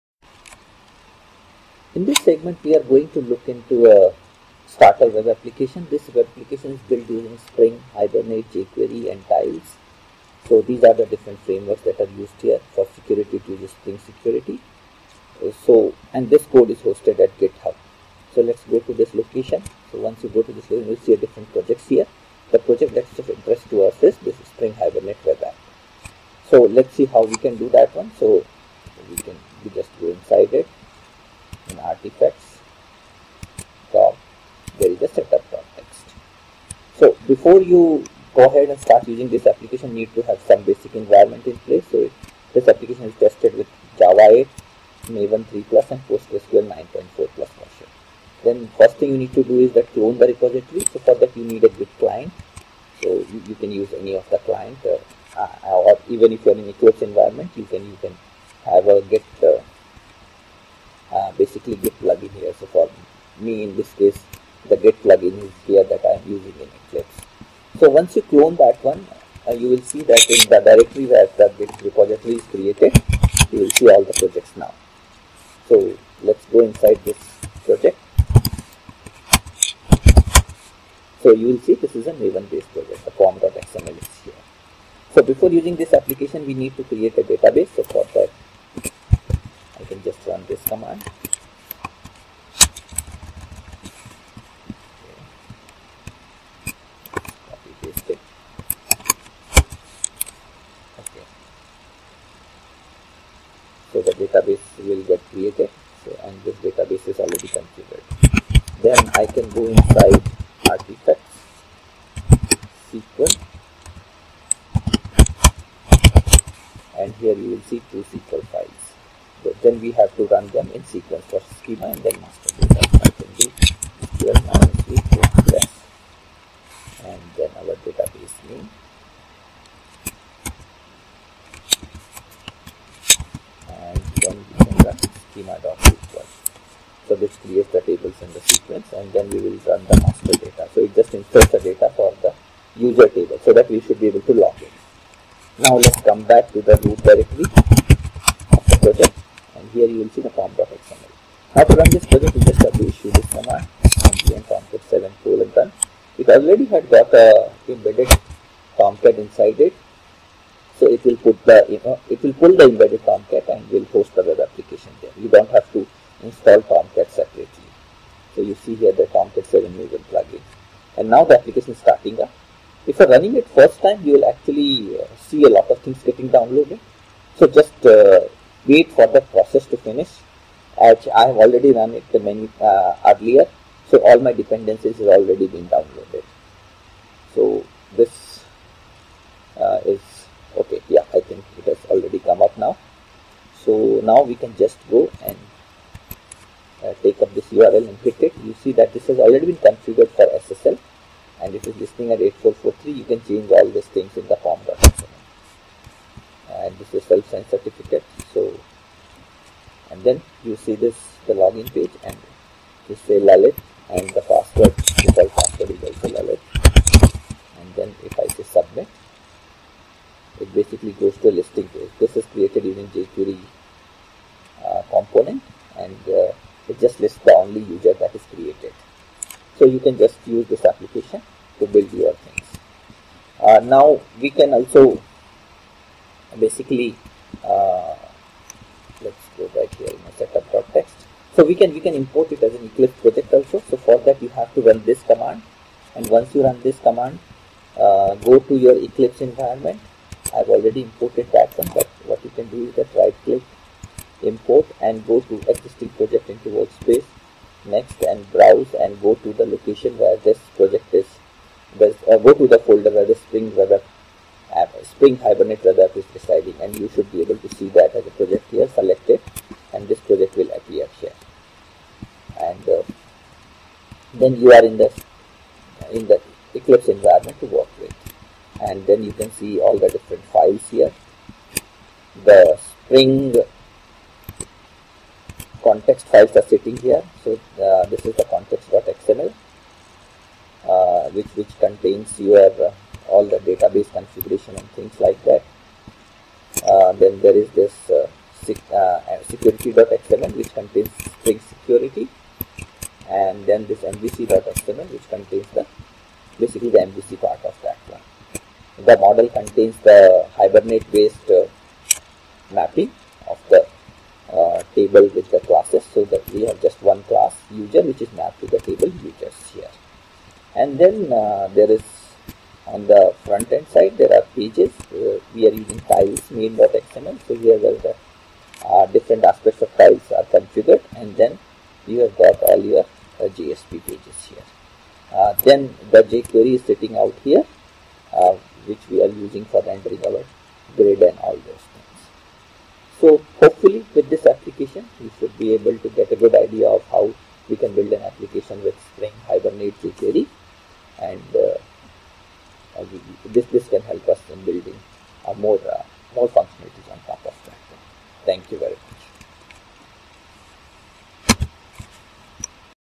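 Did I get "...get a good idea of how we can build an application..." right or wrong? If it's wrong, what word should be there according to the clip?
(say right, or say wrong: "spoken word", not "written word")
right.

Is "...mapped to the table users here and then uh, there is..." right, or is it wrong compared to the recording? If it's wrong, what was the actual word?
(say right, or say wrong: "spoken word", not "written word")
right.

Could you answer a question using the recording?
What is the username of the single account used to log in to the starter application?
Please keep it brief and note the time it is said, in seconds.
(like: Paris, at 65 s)
Lalit, at 213 s.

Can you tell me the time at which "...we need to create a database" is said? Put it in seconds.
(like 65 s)
86 s.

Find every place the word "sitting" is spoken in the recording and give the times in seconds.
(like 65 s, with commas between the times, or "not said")
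286 s, 336 s.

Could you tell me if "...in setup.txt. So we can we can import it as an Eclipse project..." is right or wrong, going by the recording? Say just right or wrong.
right.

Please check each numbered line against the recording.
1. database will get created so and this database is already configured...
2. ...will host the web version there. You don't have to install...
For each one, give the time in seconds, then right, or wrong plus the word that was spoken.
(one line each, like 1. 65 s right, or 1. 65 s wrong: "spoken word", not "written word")
1. 104 s right
2. 163 s wrong: "application", not "version".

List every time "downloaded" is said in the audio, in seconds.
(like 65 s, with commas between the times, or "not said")
176 s, 185 s.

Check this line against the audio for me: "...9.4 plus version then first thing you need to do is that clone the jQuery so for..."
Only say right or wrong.
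wrong.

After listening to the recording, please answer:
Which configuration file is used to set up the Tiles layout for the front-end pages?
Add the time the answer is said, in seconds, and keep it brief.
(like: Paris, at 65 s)
main.xml, at 326 s.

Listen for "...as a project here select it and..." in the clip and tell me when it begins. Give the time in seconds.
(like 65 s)
267 s.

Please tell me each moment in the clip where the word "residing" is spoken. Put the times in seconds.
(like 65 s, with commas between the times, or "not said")
266 s.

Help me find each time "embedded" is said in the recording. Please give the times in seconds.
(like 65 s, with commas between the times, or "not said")
157 s, 162 s.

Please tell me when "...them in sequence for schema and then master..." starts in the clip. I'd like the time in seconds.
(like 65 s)
120 s.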